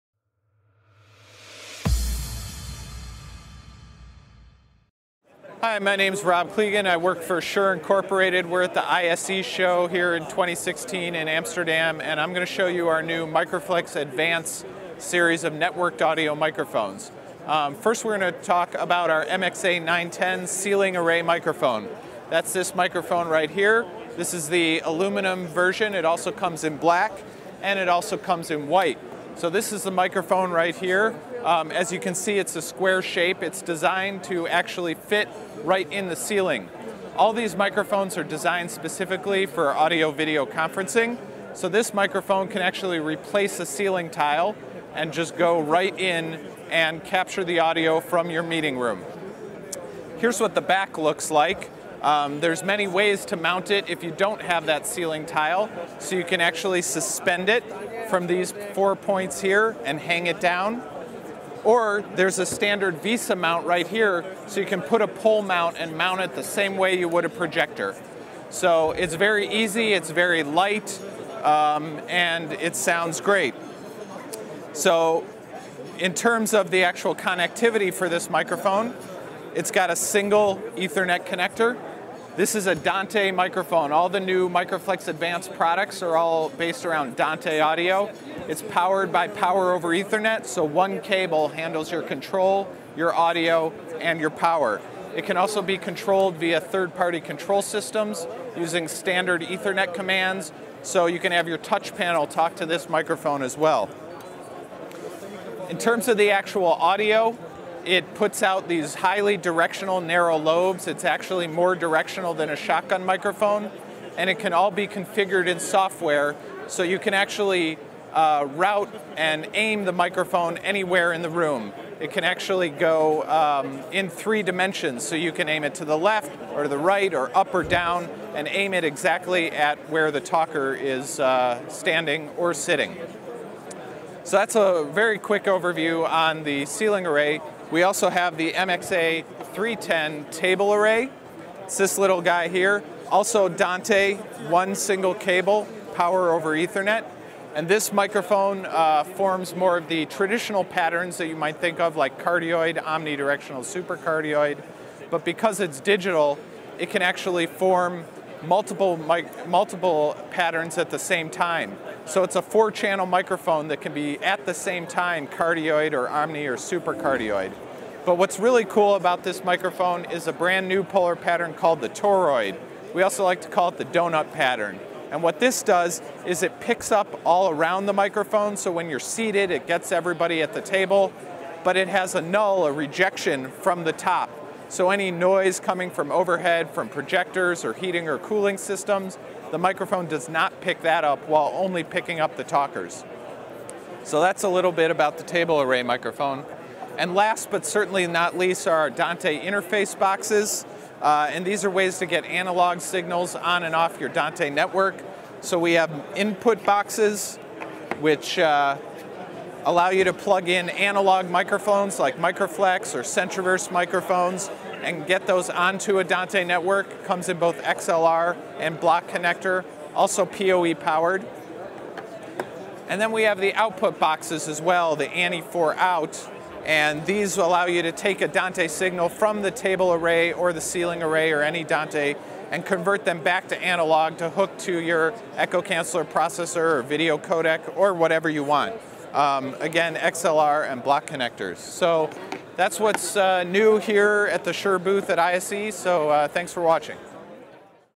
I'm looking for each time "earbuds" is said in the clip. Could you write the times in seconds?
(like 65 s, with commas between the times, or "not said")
not said.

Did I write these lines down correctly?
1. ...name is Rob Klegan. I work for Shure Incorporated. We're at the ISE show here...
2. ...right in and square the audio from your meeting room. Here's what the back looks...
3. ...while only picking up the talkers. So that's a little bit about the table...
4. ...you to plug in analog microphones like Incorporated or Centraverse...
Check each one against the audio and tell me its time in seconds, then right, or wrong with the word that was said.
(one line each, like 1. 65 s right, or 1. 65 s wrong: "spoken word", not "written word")
1. 5 s right
2. 45 s wrong: "capture", not "square"
3. 191 s right
4. 209 s wrong: "Microflex", not "Incorporated".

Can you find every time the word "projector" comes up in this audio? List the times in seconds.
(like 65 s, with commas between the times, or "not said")
67 s, 186 s.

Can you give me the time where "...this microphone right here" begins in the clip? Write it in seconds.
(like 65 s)
22 s.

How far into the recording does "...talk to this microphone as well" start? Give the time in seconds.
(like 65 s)
102 s.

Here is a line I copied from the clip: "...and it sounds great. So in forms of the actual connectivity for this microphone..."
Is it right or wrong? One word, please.
wrong.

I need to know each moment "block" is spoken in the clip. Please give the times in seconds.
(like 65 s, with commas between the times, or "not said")
218 s, 240 s.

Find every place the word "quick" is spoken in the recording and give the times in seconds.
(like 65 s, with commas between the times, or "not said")
135 s.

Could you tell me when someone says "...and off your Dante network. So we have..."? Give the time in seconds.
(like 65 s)
203 s.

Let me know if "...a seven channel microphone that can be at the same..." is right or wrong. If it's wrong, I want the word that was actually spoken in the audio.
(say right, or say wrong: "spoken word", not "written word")
wrong: "four", not "seven".